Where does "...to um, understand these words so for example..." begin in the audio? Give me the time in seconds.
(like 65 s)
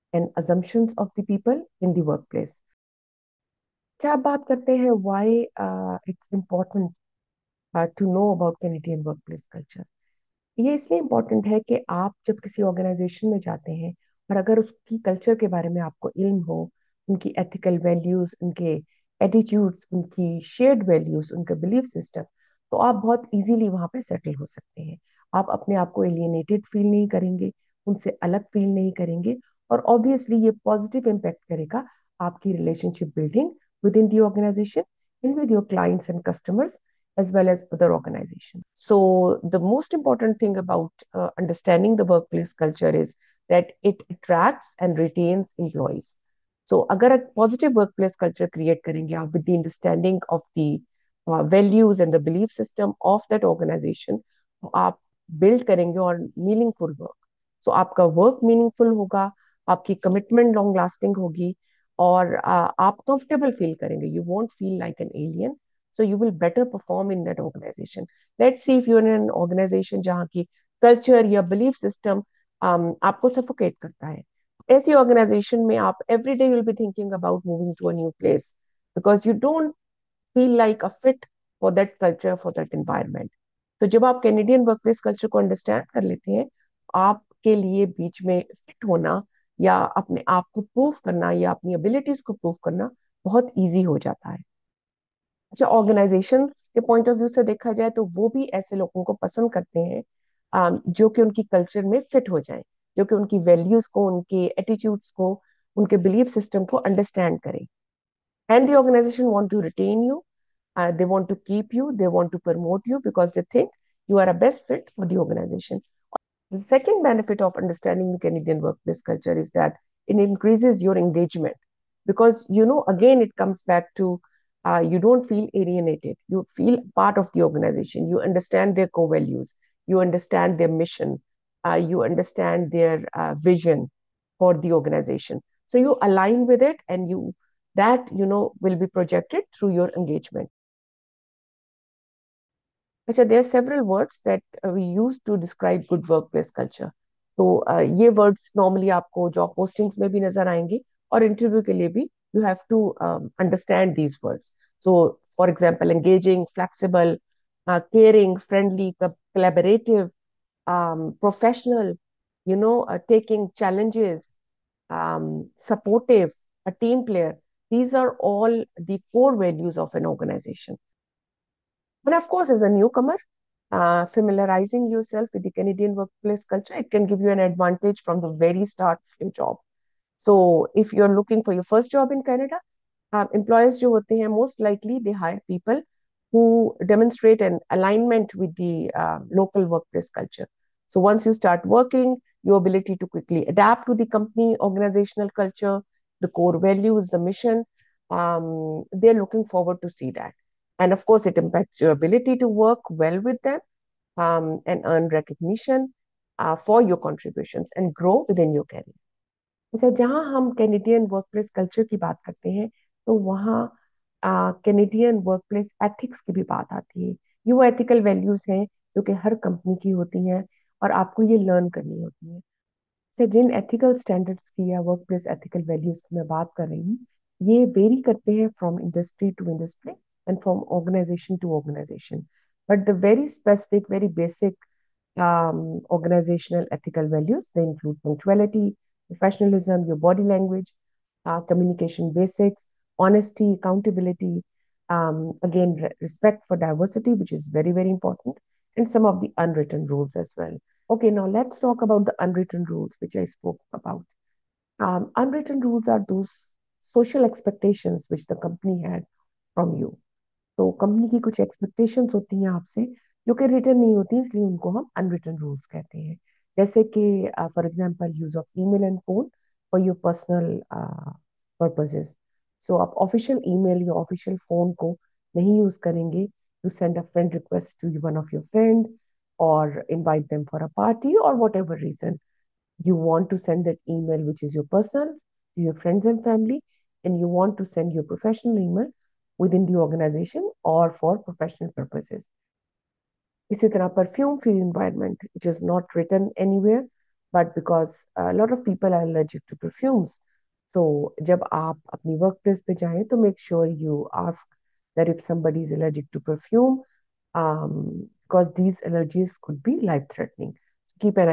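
152 s.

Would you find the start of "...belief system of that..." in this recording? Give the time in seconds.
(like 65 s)
52 s.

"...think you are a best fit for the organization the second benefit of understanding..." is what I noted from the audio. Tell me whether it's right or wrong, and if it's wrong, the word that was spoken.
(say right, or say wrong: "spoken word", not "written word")
right.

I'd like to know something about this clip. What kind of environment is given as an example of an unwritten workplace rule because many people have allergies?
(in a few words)
Perfume free environment.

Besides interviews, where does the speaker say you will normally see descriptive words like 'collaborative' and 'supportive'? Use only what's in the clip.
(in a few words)
Job postings.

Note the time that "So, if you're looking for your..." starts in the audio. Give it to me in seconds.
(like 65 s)
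180 s.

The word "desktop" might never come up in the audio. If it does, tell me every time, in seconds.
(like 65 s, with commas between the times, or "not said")
not said.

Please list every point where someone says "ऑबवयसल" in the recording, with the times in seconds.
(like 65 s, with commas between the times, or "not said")
29 s.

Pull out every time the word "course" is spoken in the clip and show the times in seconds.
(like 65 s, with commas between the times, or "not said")
172 s, 201 s.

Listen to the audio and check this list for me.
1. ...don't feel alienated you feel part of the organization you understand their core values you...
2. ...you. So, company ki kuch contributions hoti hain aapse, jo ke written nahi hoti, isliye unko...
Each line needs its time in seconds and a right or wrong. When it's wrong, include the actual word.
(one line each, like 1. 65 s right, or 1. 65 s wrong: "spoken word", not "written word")
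1. 124 s right
2. 259 s wrong: "expectations", not "contributions".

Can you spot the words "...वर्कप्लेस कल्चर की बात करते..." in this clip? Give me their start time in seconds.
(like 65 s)
211 s.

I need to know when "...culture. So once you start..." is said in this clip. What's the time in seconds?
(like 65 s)
190 s.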